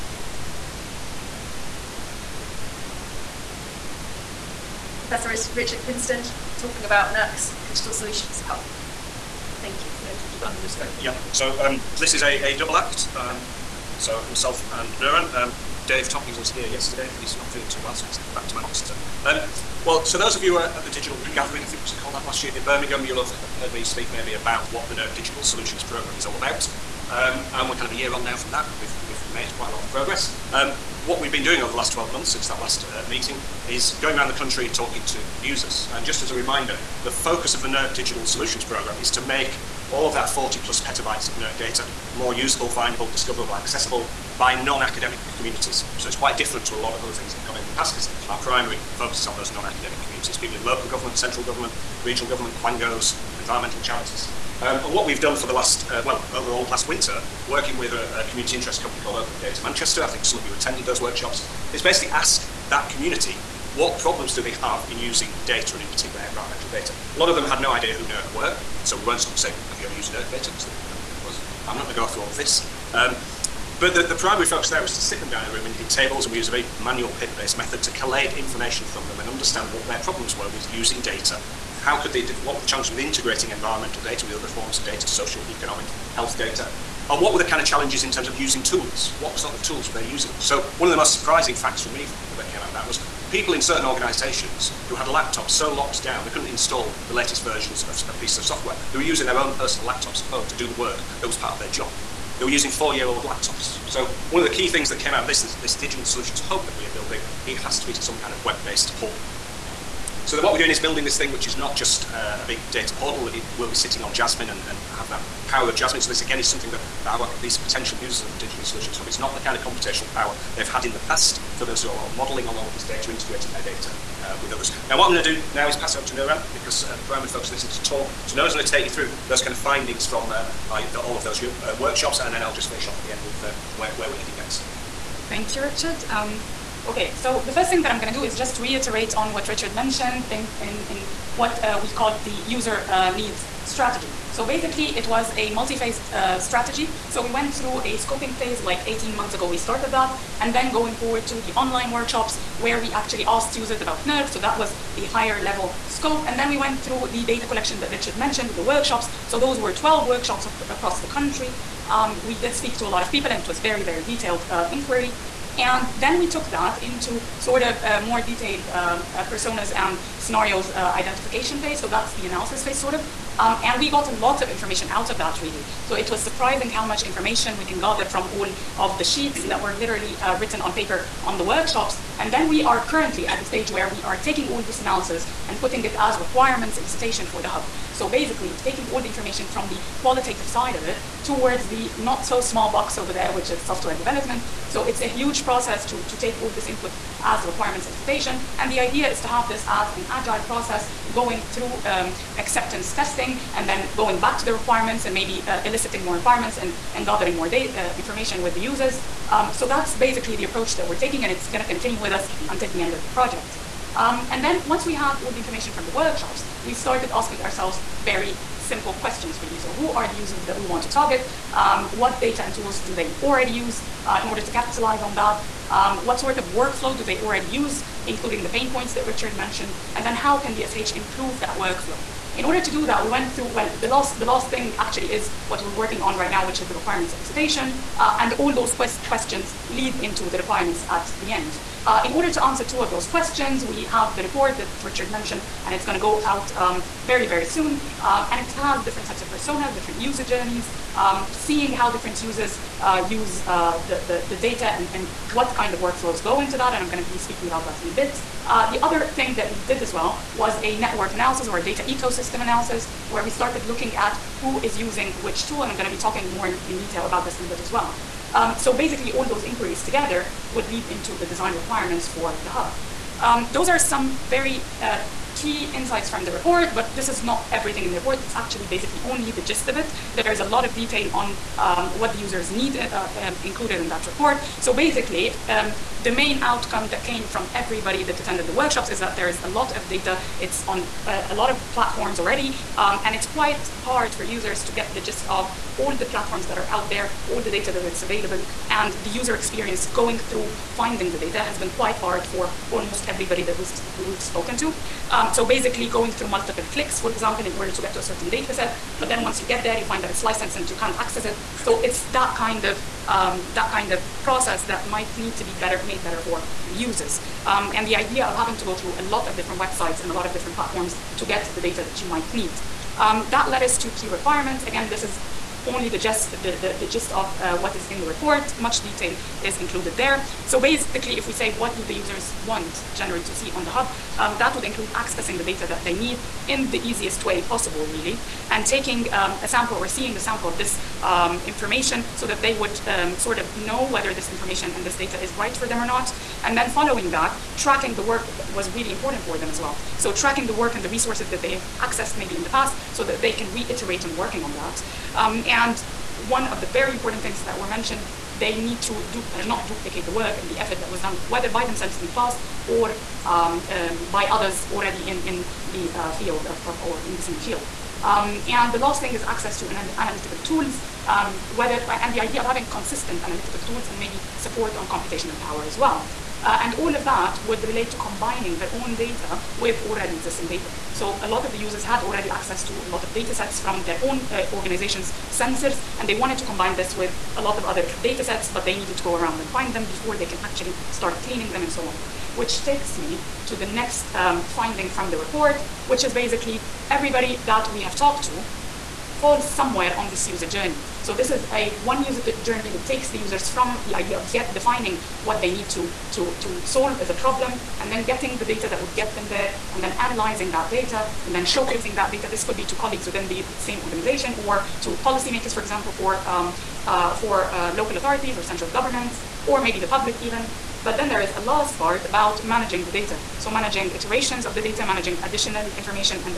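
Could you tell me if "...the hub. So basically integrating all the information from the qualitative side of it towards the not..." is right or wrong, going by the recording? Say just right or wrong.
wrong.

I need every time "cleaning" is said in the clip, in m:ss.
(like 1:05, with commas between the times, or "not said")
6:31.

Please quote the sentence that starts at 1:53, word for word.
It will be sitting on JASMIN and, and have that power of JASMIN.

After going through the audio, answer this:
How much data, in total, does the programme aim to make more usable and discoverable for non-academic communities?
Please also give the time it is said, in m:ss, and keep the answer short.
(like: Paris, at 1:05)
40 plus petabytes, at 0:40.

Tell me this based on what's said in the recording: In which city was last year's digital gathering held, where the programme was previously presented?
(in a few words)
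Birmingham.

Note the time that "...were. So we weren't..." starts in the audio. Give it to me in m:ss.
1:08.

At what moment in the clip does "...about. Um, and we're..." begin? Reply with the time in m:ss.
0:26.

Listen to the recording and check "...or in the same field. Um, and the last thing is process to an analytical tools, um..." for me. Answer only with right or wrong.
wrong.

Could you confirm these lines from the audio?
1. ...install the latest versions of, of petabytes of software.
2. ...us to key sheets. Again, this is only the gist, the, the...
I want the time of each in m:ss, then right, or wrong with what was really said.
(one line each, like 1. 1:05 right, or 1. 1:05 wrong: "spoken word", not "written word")
1. 1:36 wrong: "pieces", not "petabytes"
2. 5:23 wrong: "requirements", not "sheets".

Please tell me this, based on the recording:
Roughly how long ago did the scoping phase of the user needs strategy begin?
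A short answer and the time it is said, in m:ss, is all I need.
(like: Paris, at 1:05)
18 months ago, at 2:28.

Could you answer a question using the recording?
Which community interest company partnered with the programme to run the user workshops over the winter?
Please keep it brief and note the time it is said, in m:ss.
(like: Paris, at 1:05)
Open Data Manchester, at 0:59.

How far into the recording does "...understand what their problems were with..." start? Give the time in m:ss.
1:19.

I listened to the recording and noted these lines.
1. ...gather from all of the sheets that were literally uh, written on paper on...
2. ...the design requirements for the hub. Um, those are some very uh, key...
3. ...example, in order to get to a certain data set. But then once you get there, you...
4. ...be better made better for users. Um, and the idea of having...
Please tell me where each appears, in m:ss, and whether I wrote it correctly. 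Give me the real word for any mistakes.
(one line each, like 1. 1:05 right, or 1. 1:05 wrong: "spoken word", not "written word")
1. 2:57 right
2. 4:31 right
3. 5:07 right
4. 5:15 right.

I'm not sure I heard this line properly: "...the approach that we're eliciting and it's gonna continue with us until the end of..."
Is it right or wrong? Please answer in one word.
wrong.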